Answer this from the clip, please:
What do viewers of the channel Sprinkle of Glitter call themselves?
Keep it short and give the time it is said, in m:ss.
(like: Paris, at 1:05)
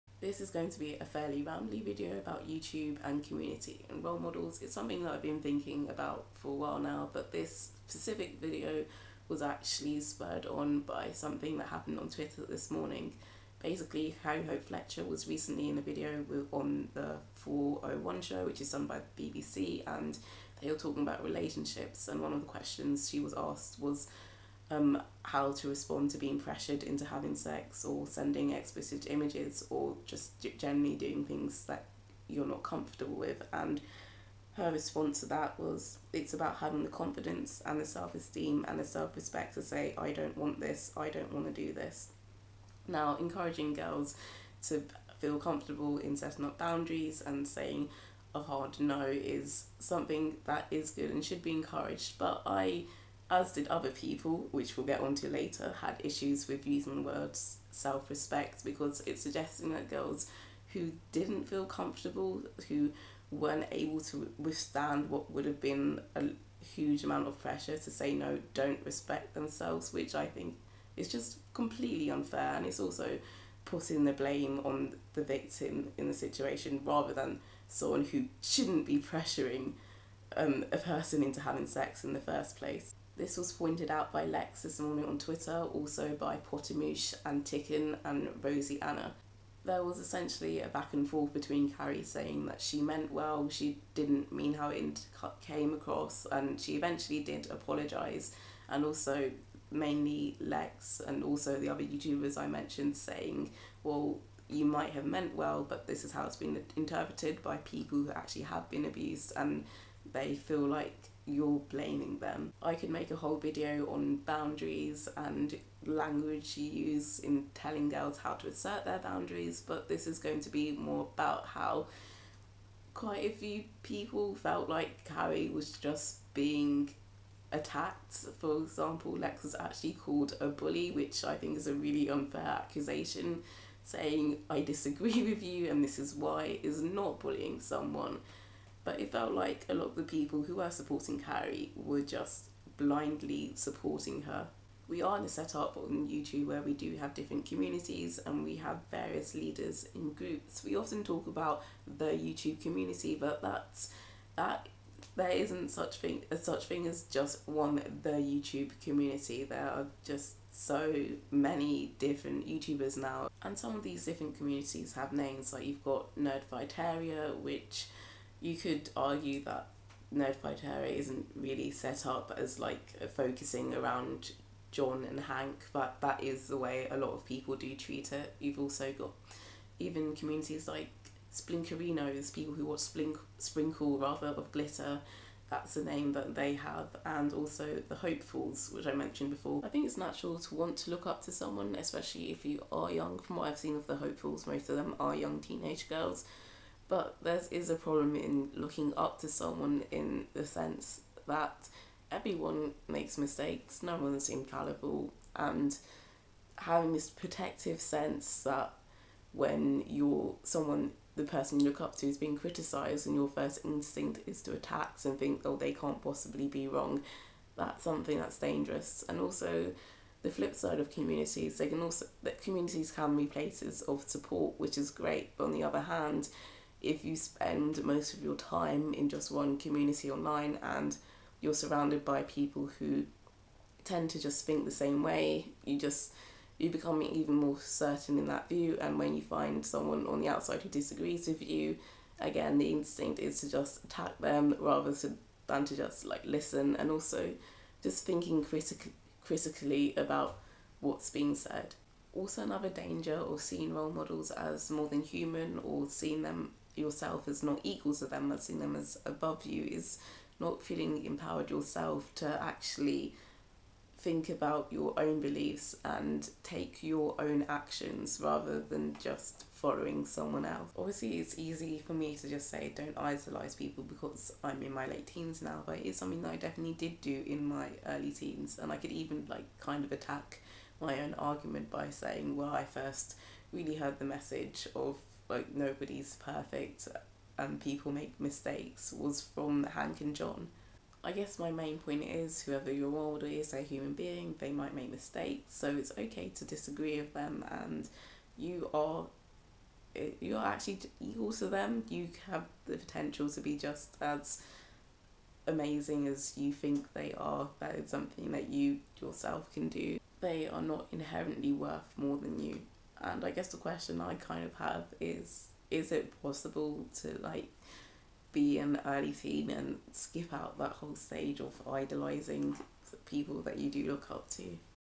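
Splinkerinos, at 3:01.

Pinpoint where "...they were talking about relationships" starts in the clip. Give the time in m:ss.
0:20.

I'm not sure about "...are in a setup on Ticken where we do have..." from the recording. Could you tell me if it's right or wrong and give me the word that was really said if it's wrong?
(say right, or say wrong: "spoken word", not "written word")
wrong: "YouTube", not "Ticken".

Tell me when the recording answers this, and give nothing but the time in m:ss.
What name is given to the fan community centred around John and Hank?
2:46.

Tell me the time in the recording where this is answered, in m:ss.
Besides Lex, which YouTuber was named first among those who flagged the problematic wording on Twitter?
1:26.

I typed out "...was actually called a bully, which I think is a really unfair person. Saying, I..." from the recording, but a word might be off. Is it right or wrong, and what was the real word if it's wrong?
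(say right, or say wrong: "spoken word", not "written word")
wrong: "accusation", not "person".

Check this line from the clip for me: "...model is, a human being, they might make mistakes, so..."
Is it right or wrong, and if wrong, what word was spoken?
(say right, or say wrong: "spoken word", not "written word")
right.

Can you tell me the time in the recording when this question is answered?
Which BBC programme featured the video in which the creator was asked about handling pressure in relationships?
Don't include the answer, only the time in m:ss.
0:16.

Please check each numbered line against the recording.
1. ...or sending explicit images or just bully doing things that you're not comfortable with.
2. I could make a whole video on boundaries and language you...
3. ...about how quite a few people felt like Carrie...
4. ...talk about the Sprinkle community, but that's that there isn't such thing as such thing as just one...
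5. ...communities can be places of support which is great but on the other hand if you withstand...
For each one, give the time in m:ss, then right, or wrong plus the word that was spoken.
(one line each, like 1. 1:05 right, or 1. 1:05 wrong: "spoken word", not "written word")
1. 0:27 wrong: "generally", not "bully"
2. 1:52 right
3. 2:01 right
4. 2:31 wrong: "YouTube", not "Sprinkle"
5. 3:42 wrong: "spend", not "withstand".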